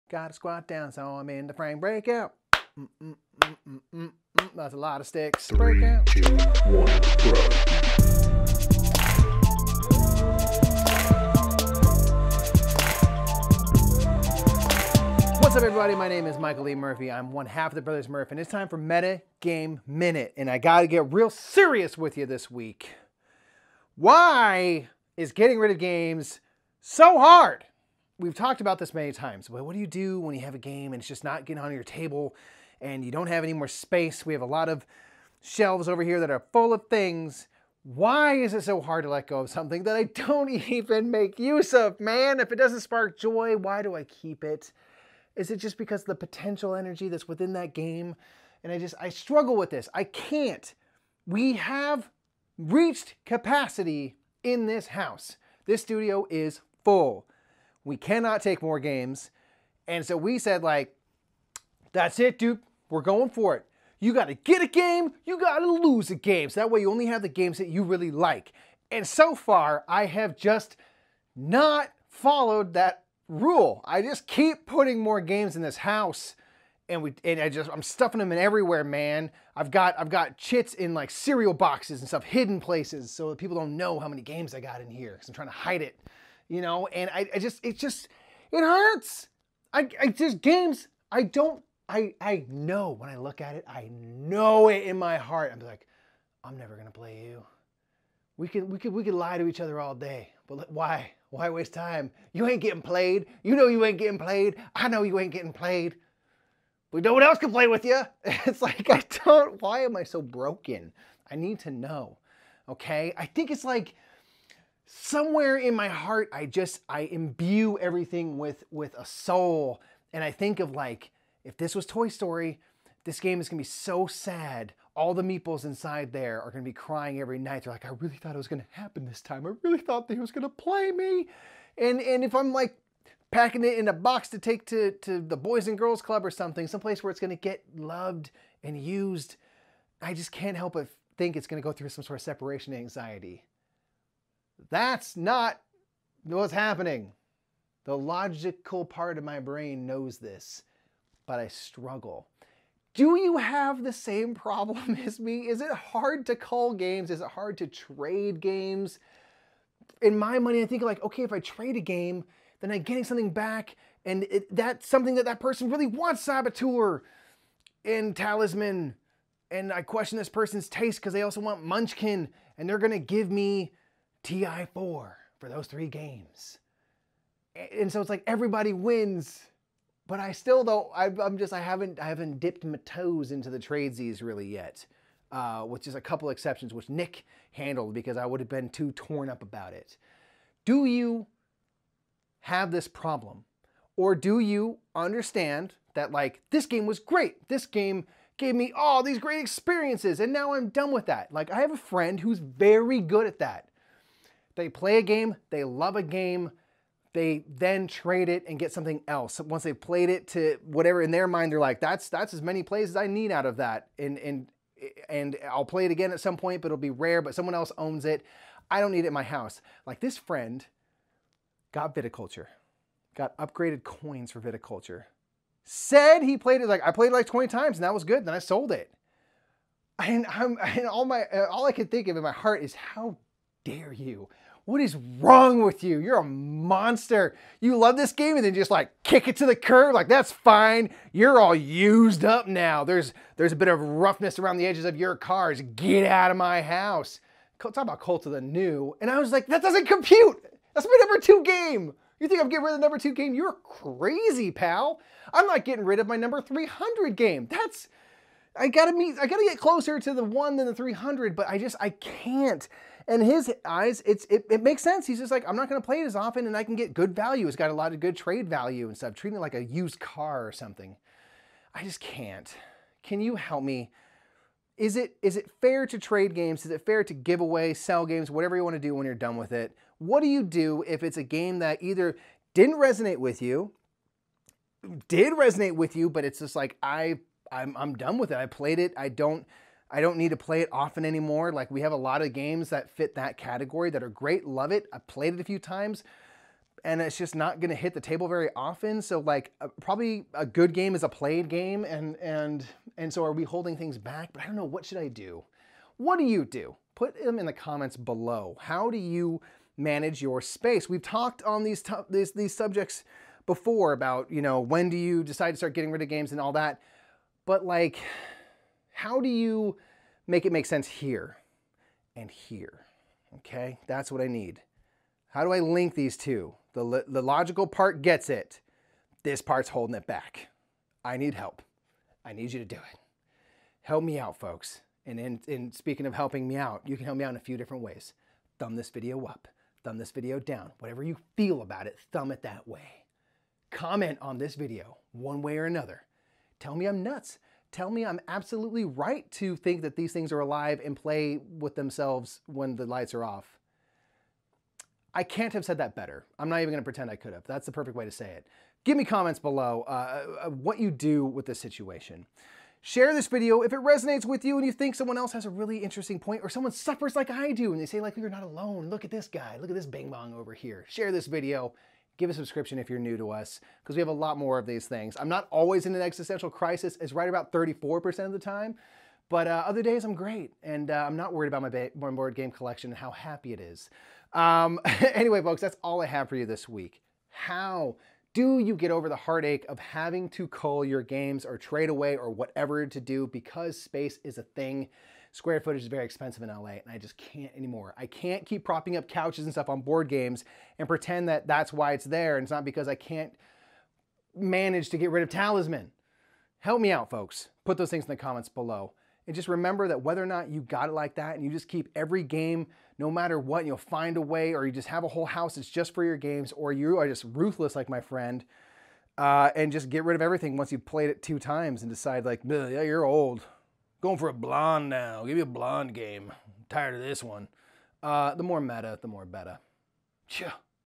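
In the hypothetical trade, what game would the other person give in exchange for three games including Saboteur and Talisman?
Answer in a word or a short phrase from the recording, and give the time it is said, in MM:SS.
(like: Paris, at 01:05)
TI4, at 02:54.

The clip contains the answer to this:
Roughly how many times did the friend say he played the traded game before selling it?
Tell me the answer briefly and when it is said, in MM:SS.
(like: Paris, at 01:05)
20, at 03:47.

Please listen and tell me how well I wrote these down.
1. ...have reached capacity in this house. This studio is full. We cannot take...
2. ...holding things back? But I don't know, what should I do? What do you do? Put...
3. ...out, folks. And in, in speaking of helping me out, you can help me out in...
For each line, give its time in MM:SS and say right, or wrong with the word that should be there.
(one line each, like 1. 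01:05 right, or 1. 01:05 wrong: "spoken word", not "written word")
1. 00:51 right
2. 05:03 right
3. 05:34 right.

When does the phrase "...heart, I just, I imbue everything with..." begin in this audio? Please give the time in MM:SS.
01:55.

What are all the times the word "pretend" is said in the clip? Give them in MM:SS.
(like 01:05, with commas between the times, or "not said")
05:56, 06:40.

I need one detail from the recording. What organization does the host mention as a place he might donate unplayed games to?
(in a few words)
Boys and Girls Club.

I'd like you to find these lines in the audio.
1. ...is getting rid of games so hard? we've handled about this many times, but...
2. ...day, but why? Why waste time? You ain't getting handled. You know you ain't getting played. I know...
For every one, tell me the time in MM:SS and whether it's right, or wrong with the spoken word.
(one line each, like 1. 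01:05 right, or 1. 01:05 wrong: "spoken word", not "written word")
1. 00:25 wrong: "talked", not "handled"
2. 01:39 wrong: "played", not "handled".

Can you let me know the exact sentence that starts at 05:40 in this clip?
Whatever you feel about it, thumb it that way.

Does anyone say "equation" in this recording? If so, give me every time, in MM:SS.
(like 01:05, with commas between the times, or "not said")
not said.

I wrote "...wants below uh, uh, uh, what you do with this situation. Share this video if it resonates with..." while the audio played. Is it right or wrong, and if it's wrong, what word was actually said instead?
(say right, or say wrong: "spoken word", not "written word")
wrong: "comments", not "wants".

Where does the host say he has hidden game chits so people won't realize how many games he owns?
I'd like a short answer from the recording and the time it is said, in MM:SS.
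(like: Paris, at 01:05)
cereal boxes, at 01:21.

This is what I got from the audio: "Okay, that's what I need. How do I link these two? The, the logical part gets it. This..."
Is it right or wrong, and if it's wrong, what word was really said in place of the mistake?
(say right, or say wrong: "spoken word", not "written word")
right.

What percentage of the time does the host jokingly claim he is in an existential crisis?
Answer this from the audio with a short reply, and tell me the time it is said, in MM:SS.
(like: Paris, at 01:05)
34%, at 06:17.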